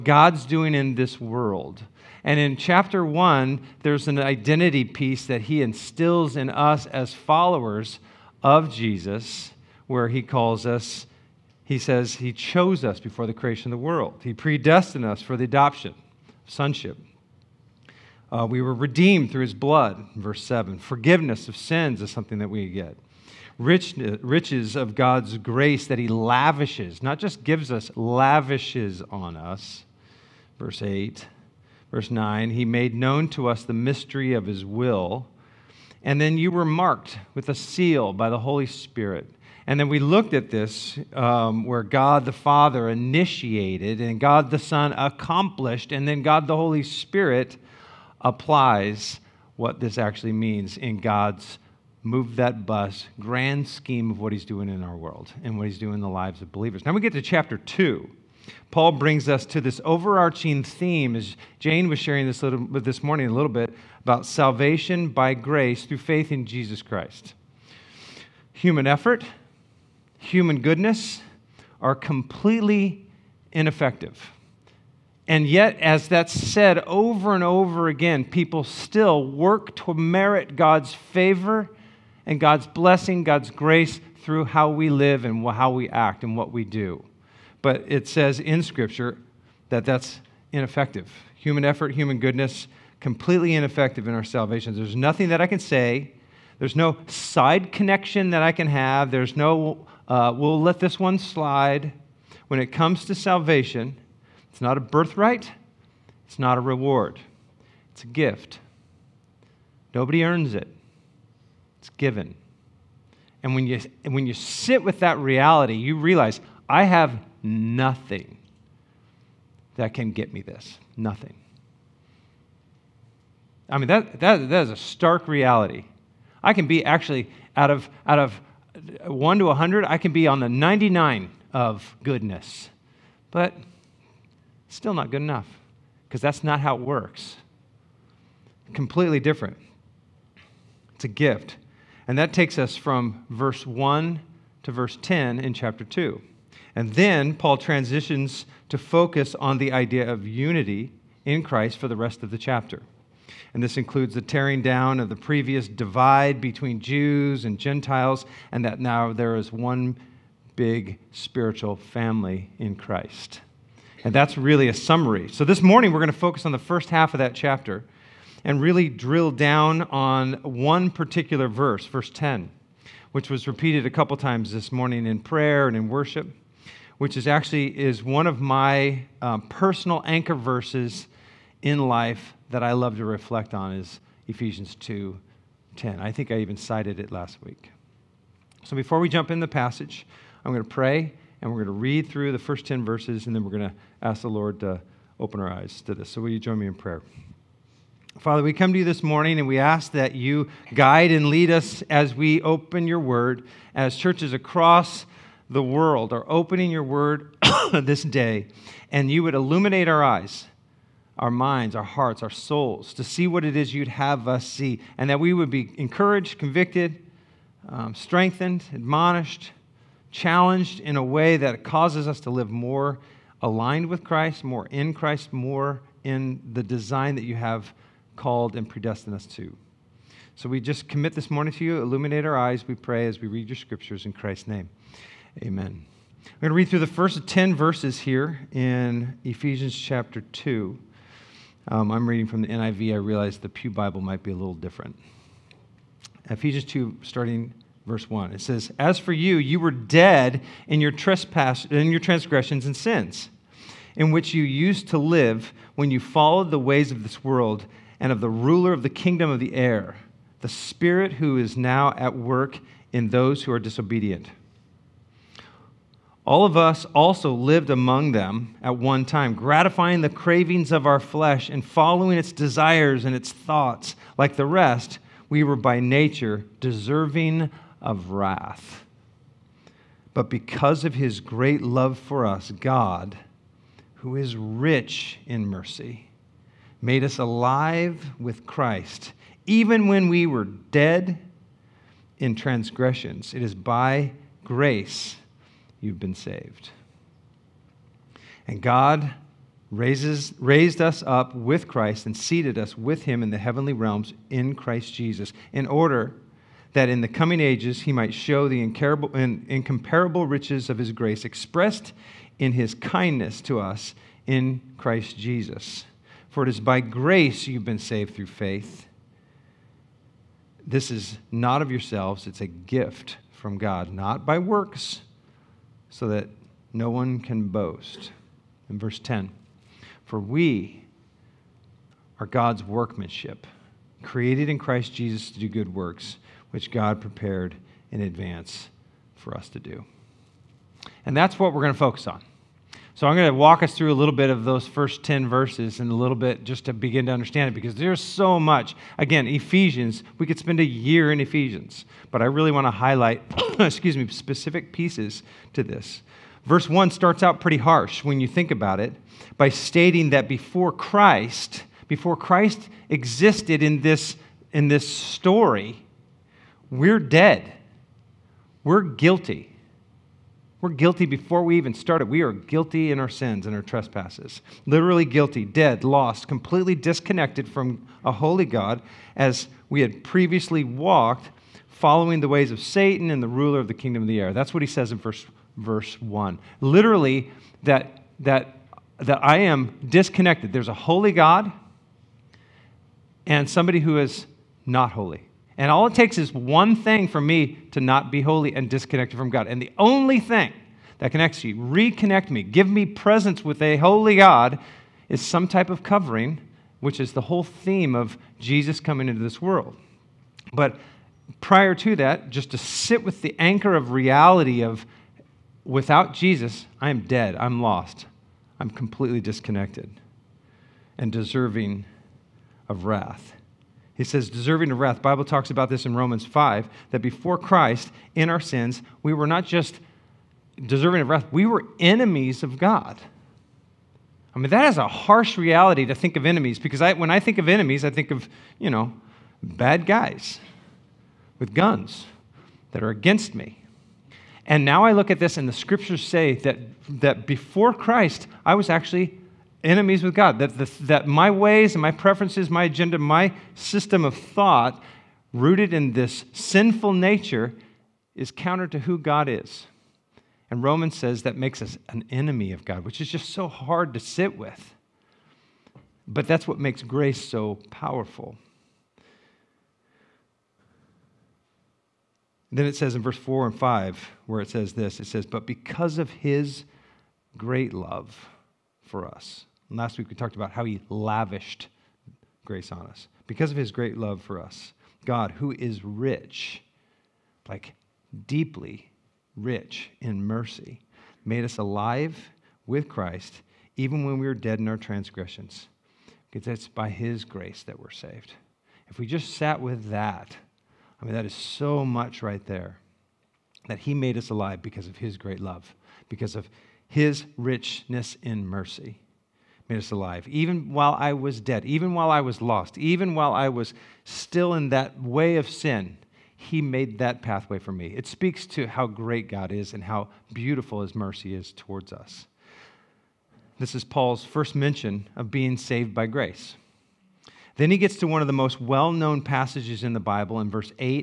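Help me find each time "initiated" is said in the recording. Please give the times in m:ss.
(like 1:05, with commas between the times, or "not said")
0:42.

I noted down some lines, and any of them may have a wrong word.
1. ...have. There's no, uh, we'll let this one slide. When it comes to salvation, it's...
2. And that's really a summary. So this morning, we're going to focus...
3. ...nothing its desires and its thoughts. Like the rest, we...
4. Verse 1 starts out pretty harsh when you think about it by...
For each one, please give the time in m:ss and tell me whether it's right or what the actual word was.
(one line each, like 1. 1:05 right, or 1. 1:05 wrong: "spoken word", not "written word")
1. 1:38 right
2. 2:44 right
3. 4:31 wrong: "following", not "nothing"
4. 5:56 right.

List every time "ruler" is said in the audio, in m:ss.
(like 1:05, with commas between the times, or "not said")
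4:18, 6:23.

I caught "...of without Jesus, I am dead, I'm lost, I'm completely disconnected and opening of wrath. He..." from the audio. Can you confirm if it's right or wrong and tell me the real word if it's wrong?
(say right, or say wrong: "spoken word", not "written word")
wrong: "deserving", not "opening".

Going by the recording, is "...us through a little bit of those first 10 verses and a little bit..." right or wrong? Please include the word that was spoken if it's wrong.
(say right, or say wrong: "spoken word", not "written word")
right.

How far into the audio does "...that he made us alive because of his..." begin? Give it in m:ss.
8:23.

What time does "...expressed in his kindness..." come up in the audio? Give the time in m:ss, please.
5:11.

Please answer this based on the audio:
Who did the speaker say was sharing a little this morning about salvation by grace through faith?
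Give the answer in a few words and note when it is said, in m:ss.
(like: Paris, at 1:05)
Jane, at 1:01.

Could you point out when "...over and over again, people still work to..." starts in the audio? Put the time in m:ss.
1:16.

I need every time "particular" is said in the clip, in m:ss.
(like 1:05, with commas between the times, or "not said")
2:50.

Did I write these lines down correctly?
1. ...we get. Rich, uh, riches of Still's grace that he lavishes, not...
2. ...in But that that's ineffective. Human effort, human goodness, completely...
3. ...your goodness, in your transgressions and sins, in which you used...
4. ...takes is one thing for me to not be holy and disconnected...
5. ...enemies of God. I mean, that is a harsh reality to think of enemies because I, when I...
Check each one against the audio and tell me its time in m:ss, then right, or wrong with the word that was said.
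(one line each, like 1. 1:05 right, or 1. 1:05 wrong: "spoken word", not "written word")
1. 0:22 wrong: "God", not "Still"
2. 1:28 wrong: "Scripture", not "But"
3. 4:10 wrong: "trespass", not "goodness"
4. 6:35 right
5. 7:11 right.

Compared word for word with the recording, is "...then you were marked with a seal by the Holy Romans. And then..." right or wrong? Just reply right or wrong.
wrong.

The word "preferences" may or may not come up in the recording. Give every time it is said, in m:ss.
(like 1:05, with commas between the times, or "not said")
7:31.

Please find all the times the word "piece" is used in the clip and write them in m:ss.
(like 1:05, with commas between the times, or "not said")
0:04, 5:54.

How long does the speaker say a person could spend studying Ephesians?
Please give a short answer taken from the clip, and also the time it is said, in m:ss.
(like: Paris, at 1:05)
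a year, at 5:50.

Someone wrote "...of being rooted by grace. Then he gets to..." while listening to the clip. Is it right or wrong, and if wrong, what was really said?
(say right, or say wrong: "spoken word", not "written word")
wrong: "saved", not "rooted".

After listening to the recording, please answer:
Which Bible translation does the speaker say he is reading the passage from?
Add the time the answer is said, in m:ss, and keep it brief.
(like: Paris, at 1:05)
NIV, at 4:02.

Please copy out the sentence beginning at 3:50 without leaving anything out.
So we just commit this morning to you.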